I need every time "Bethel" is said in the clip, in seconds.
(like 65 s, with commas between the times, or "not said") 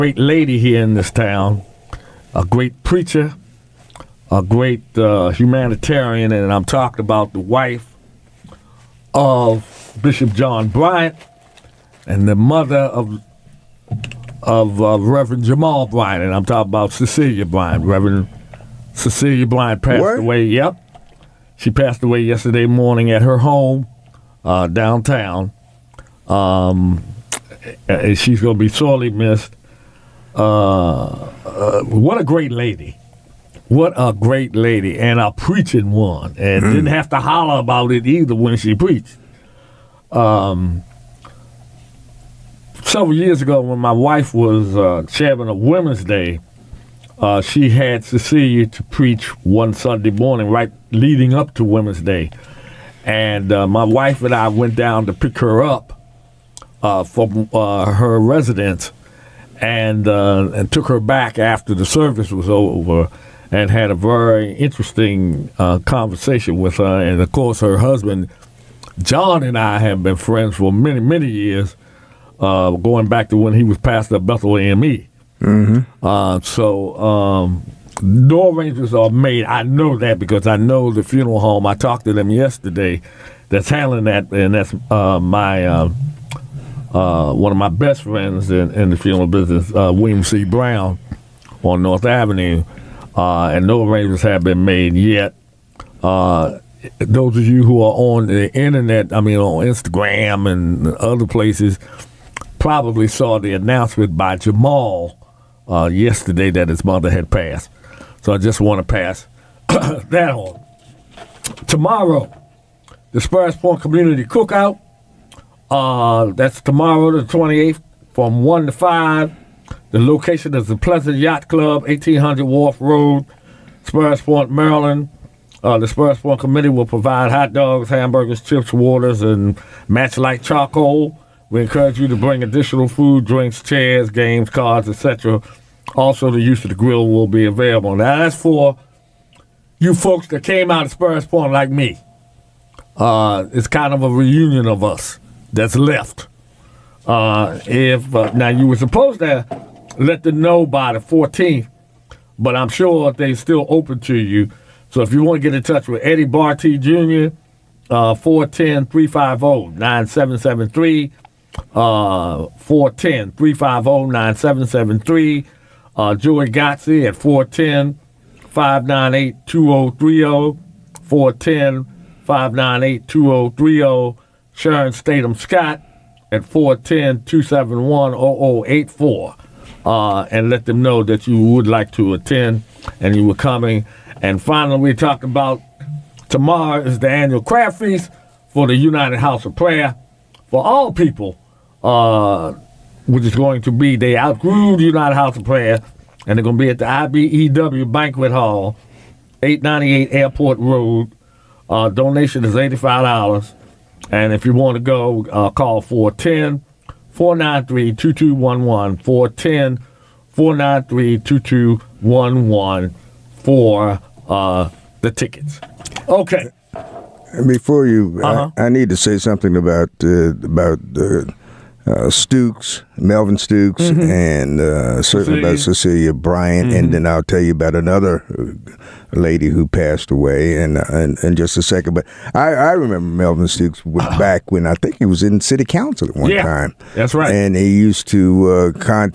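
74 s.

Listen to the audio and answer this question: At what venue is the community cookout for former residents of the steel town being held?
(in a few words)
Pleasant Yacht Club.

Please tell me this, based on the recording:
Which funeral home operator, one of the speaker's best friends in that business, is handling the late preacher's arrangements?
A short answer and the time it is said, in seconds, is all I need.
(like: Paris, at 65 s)
William C. Brown, at 89 s.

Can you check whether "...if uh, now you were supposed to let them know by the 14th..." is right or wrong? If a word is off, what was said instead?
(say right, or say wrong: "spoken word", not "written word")
right.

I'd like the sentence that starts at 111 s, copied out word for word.
Tomorrow, the Sparrows Point Community Cookout.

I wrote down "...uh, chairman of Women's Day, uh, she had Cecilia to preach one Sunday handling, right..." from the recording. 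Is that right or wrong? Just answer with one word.
wrong.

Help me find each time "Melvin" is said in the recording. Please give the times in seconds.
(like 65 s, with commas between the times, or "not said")
222 s, 233 s.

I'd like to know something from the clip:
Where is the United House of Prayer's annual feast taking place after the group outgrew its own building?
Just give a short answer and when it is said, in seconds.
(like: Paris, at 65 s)
IBEW Banquet Hall, at 196 s.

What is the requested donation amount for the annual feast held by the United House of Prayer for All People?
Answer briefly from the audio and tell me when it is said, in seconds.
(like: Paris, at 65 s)
$85, at 202 s.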